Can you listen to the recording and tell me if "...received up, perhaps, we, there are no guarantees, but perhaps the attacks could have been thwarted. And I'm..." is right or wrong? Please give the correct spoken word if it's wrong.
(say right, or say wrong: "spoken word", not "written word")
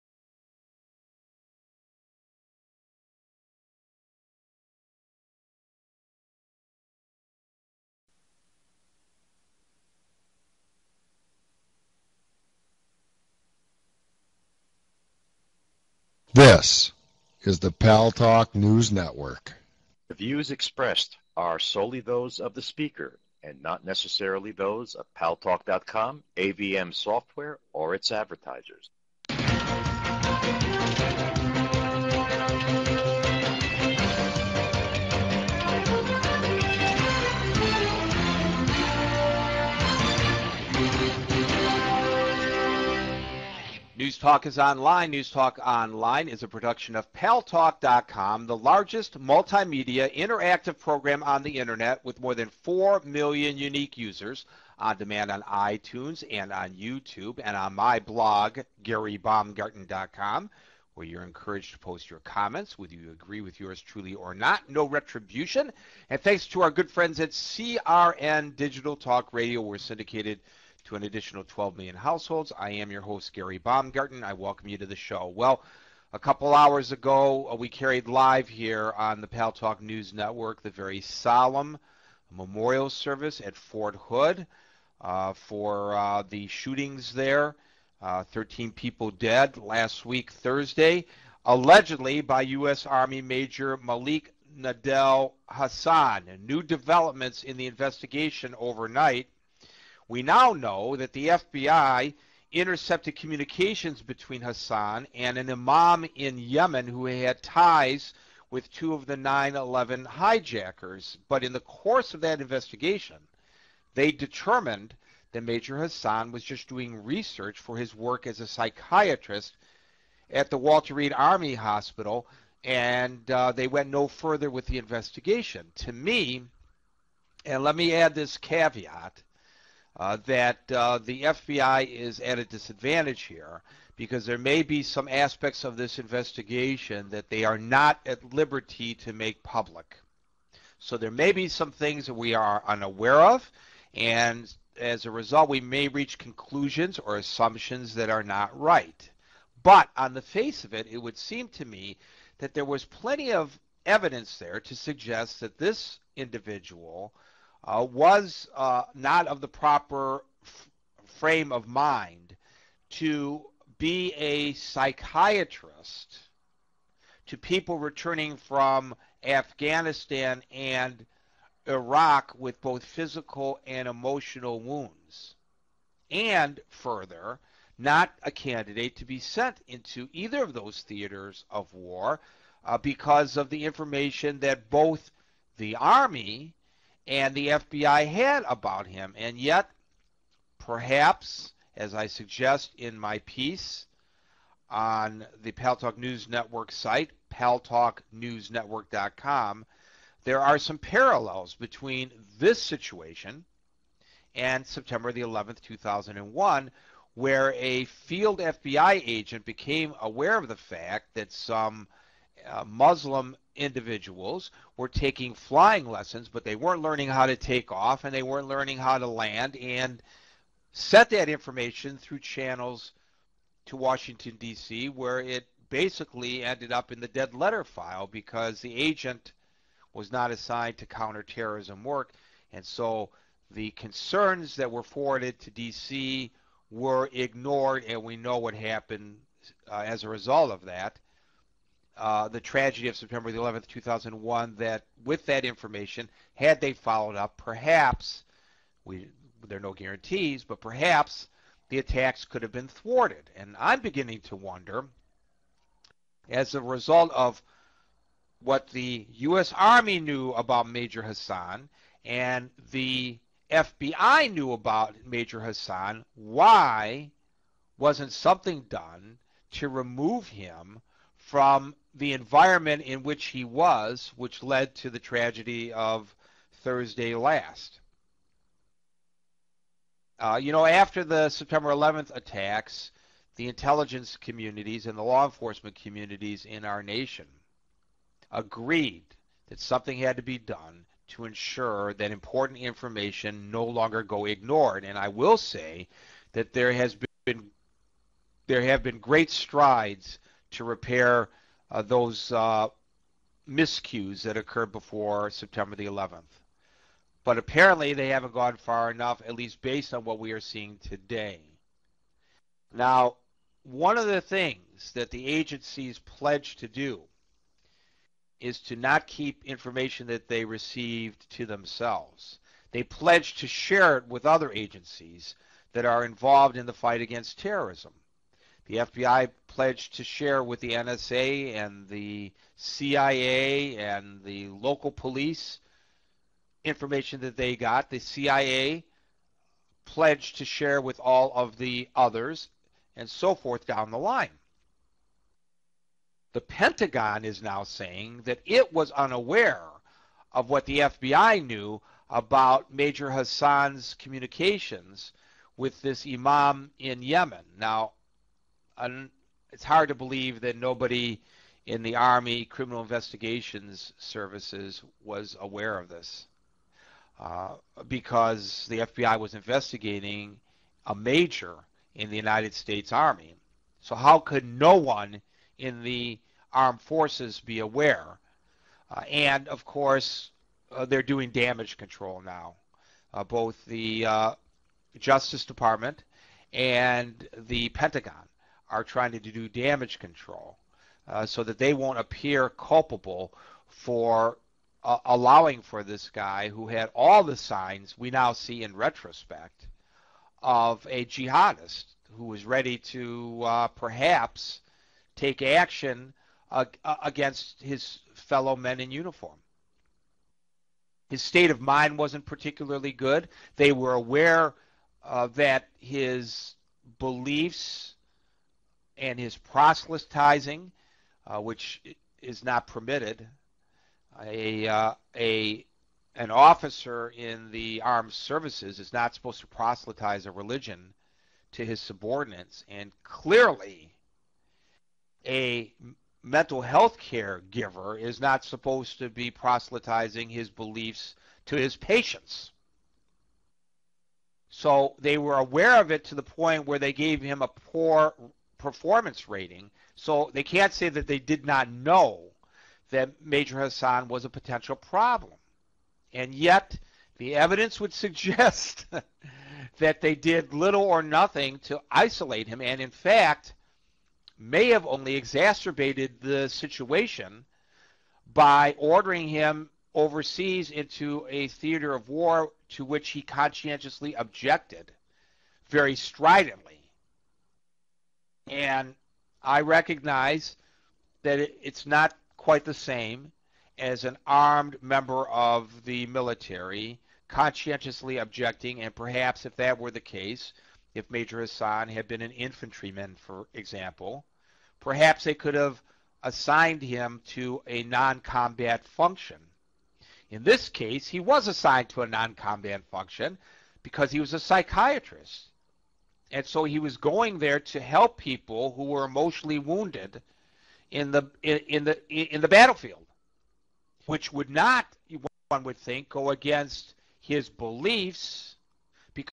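wrong: "followed", not "received".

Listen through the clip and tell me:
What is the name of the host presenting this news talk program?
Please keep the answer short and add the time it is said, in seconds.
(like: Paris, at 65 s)
Gary Baumgarten, at 73 s.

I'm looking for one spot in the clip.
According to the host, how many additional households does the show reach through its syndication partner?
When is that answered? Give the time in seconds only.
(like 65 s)
71 s.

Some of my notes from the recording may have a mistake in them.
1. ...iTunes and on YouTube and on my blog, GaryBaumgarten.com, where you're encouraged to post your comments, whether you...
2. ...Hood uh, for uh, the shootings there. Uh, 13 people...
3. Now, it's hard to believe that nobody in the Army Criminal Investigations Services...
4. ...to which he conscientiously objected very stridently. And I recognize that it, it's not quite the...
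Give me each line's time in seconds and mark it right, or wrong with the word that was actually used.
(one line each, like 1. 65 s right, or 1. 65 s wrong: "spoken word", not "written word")
1. 55 s right
2. 83 s right
3. 357 s right
4. 472 s right.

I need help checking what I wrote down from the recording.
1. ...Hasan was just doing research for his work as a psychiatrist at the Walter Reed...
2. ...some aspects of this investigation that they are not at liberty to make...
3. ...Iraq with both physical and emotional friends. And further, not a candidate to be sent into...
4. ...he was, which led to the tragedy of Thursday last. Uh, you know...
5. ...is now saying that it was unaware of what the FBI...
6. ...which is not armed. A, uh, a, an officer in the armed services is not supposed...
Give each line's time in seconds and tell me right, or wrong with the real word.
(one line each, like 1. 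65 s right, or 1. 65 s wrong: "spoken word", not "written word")
1. 115 s right
2. 134 s right
3. 171 s wrong: "wounds", not "friends"
4. 273 s right
5. 347 s right
6. 421 s wrong: "permitted", not "armed".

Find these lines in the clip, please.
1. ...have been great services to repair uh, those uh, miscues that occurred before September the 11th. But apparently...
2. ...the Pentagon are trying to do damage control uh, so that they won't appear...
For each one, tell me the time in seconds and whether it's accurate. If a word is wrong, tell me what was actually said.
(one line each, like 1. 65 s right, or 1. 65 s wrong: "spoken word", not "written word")
1. 298 s wrong: "strides", not "services"
2. 387 s right.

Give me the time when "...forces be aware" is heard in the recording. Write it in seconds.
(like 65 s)
376 s.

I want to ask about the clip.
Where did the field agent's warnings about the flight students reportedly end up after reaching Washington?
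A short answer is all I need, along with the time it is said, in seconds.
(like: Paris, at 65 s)
dead letter file, at 227 s.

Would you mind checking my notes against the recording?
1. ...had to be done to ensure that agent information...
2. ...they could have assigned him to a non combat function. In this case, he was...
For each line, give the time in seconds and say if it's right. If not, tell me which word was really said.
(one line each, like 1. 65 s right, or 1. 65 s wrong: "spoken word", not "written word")
1. 289 s wrong: "important", not "agent"
2. 495 s right.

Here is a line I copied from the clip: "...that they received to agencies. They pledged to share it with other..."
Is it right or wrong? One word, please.
wrong.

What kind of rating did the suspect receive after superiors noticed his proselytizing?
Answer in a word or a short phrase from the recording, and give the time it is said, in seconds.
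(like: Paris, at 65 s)
poor performance rating, at 447 s.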